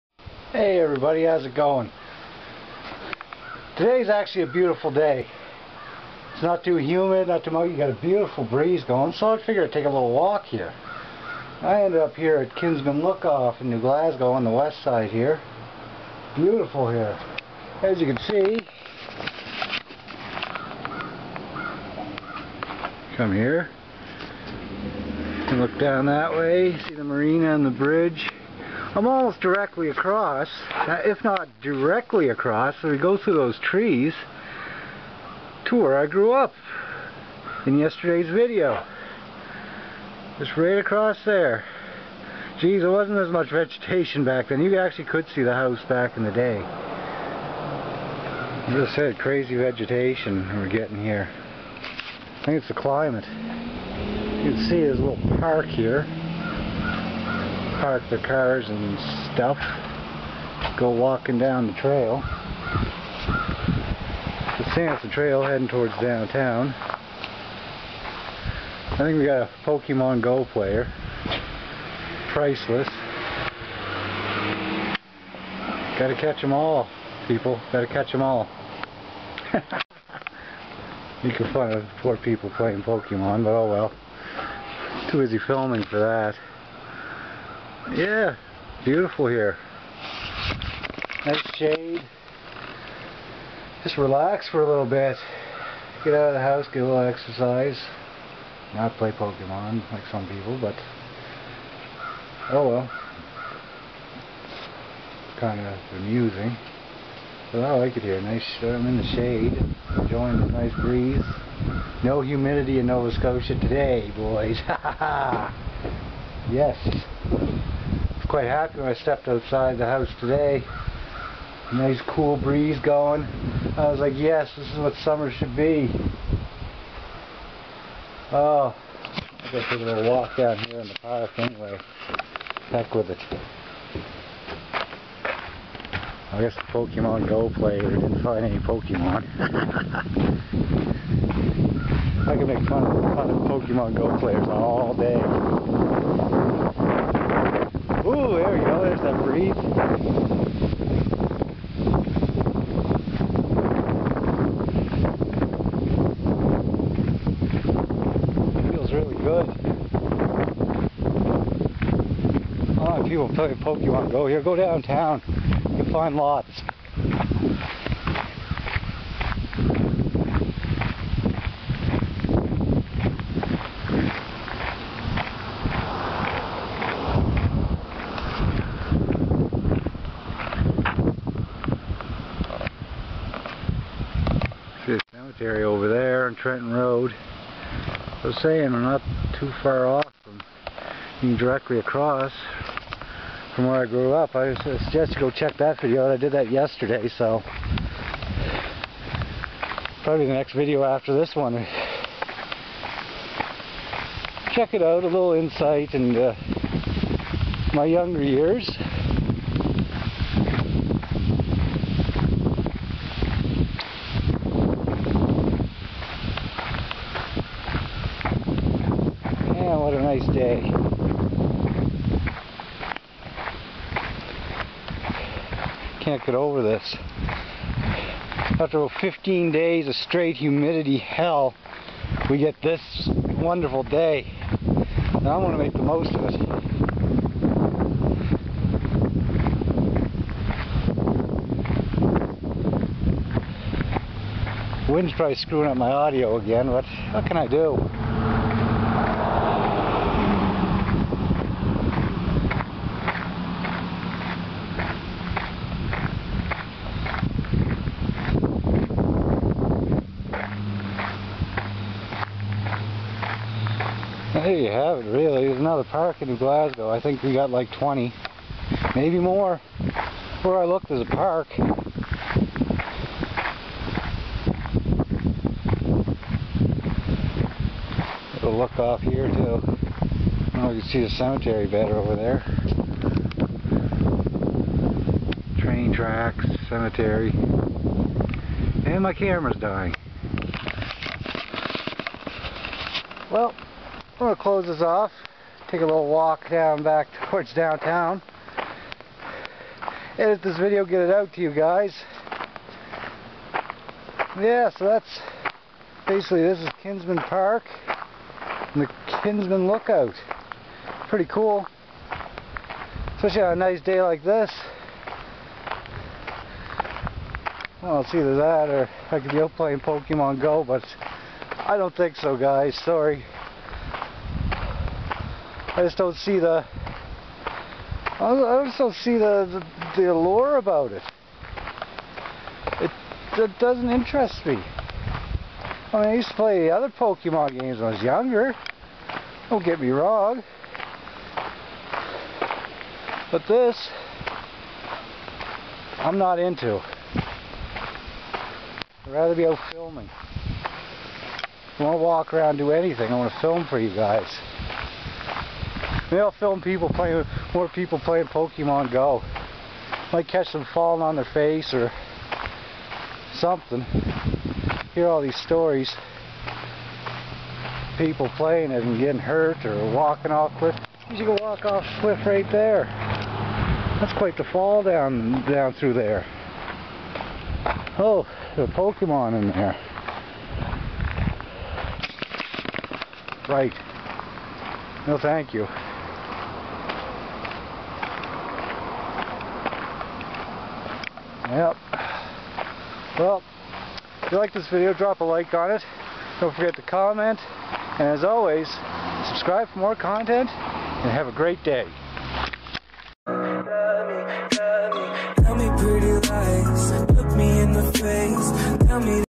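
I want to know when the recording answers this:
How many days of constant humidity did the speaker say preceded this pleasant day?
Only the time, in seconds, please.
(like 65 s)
228 s.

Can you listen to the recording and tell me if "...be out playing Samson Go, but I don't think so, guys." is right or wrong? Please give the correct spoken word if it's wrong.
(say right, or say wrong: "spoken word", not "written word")
wrong: "Pokemon", not "Samson".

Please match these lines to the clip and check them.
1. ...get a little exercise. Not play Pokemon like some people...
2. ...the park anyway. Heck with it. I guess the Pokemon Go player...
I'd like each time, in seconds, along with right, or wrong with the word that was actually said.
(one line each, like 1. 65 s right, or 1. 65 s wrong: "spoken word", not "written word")
1. 96 s right
2. 130 s right.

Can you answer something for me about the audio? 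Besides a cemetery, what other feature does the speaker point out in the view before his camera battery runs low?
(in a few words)
Train tracks.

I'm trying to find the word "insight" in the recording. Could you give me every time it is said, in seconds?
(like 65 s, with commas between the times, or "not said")
205 s.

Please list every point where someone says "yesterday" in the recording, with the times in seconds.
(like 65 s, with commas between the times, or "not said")
37 s, 196 s.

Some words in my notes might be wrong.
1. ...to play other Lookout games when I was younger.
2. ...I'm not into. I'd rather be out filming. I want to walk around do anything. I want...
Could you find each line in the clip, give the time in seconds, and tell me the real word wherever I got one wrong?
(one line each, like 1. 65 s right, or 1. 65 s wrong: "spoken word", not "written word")
1. 336 s wrong: "Pokemon", not "Lookout"
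2. 345 s right.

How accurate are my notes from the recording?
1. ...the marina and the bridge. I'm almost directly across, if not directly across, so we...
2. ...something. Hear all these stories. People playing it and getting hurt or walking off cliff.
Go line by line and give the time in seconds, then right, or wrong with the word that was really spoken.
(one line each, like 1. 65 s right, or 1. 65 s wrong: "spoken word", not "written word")
1. 26 s right
2. 363 s right.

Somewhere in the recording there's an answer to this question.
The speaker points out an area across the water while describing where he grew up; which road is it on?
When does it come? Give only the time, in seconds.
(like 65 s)
186 s.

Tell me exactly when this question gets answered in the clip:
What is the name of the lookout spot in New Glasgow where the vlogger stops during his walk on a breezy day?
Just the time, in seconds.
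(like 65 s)
12 s.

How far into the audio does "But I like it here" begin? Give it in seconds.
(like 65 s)
107 s.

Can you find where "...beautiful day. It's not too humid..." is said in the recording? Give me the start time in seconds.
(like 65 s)
4 s.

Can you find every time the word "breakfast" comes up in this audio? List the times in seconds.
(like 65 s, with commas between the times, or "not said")
not said.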